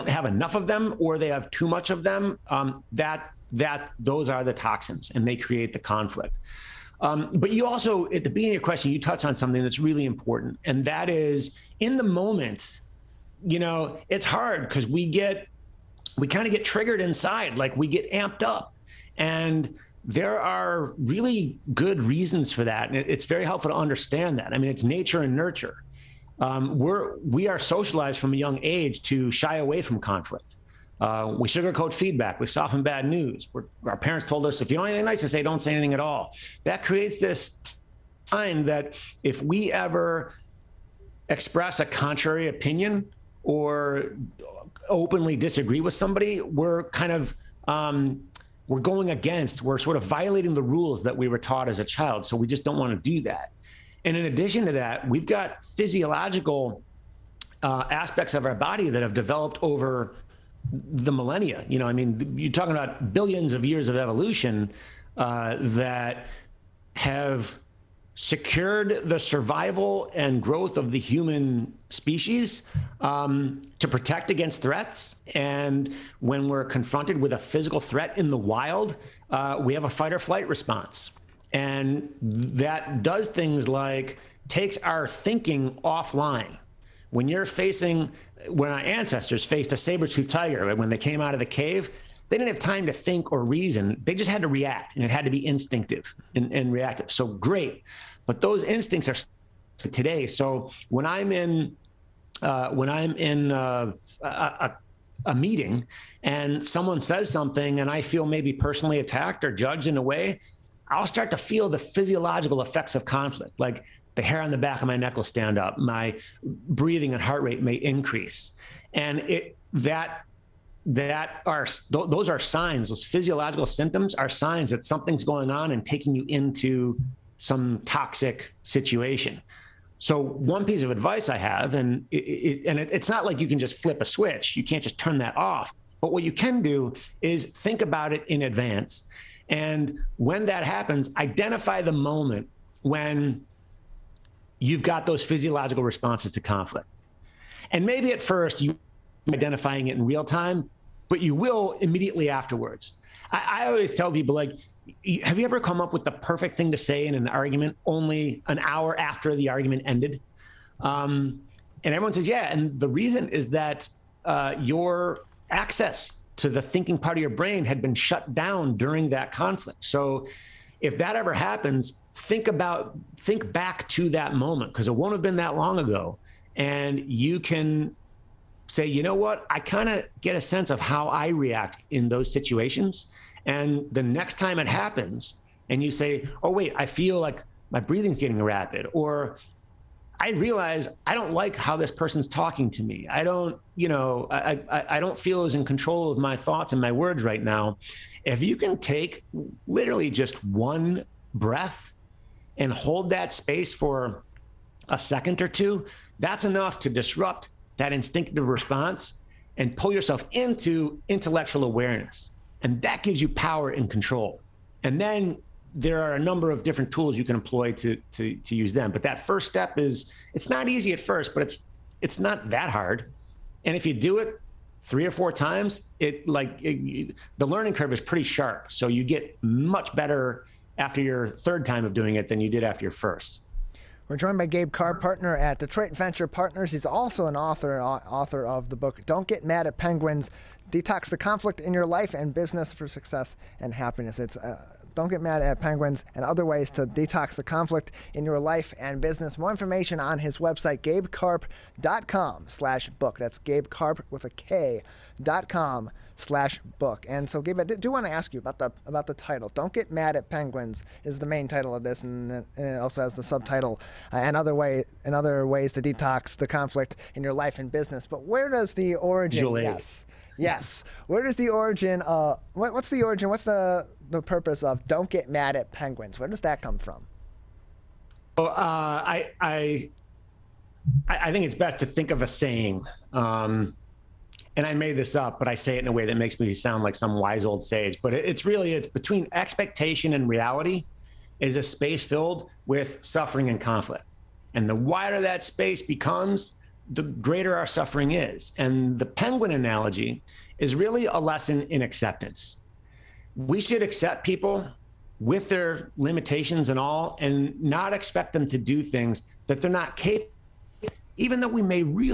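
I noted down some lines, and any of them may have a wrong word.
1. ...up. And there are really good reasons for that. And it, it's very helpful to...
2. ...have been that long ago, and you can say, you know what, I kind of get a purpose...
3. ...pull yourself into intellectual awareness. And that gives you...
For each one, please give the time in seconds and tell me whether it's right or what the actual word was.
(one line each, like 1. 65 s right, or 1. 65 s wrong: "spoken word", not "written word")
1. 18 s right
2. 175 s wrong: "sense", not "purpose"
3. 209 s right.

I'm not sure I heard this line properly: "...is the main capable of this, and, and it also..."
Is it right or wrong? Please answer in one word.
wrong.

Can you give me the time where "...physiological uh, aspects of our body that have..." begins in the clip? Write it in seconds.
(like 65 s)
55 s.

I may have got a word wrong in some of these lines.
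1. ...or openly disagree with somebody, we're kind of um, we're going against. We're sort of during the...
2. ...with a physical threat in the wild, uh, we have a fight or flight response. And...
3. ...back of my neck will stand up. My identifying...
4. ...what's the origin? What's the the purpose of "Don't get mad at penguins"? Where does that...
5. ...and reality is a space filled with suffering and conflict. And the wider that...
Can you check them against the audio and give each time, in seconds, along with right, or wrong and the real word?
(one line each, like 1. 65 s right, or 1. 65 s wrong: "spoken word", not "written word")
1. 43 s wrong: "violating", not "during"
2. 77 s right
3. 114 s wrong: "breathing", not "identifying"
4. 272 s right
5. 290 s right.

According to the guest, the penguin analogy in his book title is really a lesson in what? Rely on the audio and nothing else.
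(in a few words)
Acceptance.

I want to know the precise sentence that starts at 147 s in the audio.
And maybe at first you you're identifying it in real time, but you will immediately afterwards.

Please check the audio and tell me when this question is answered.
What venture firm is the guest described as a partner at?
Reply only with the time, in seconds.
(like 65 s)
235 s.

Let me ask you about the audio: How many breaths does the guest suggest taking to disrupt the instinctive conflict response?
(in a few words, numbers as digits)
1.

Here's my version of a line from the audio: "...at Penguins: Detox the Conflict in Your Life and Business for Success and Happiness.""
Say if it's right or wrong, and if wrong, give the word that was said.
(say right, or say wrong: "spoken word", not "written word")
right.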